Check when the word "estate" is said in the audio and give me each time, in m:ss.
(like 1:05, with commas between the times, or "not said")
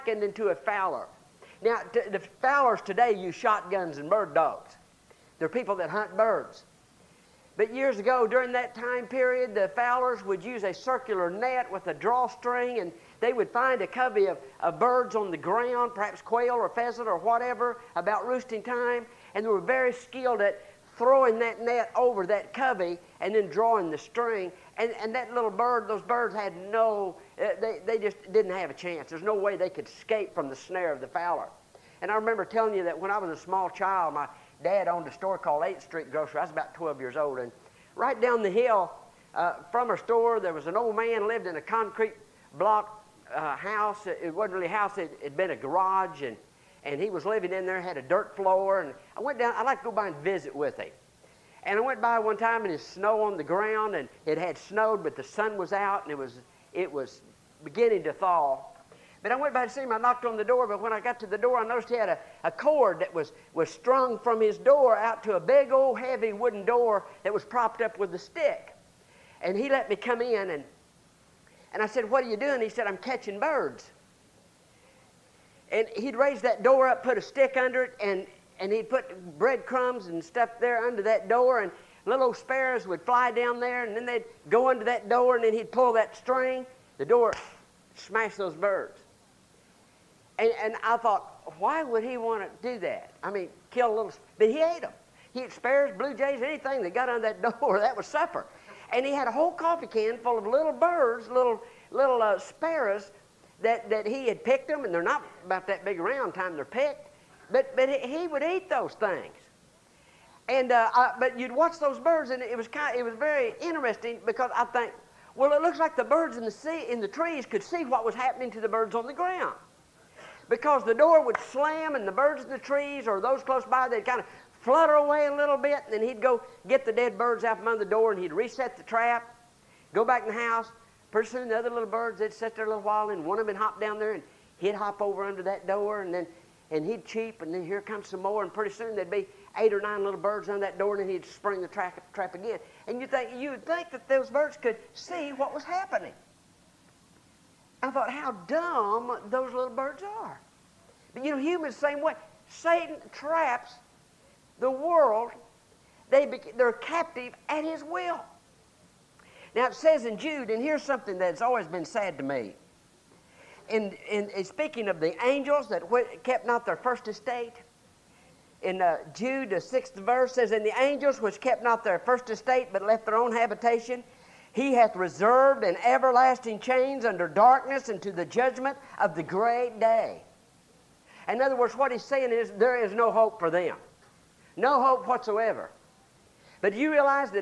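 2:47, 2:52.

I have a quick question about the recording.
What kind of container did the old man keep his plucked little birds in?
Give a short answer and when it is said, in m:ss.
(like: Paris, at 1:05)
Coffee can, at 1:39.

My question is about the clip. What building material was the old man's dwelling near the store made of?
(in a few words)
Concrete block.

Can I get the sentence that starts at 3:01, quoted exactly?
In other words, what he's saying is there is no hope for them.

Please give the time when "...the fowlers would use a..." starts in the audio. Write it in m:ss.
0:09.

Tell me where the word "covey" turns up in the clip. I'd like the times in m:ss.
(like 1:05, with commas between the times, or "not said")
0:13, 0:22.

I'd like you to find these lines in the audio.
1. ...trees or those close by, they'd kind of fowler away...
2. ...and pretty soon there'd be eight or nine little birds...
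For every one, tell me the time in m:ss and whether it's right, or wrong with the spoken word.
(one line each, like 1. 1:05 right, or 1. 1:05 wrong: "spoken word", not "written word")
1. 2:02 wrong: "flutter", not "fowler"
2. 2:18 right.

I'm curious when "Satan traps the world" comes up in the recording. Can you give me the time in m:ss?
2:32.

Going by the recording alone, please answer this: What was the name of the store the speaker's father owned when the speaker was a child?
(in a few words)
8th Street Grocery.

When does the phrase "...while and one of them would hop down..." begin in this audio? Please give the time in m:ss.
2:12.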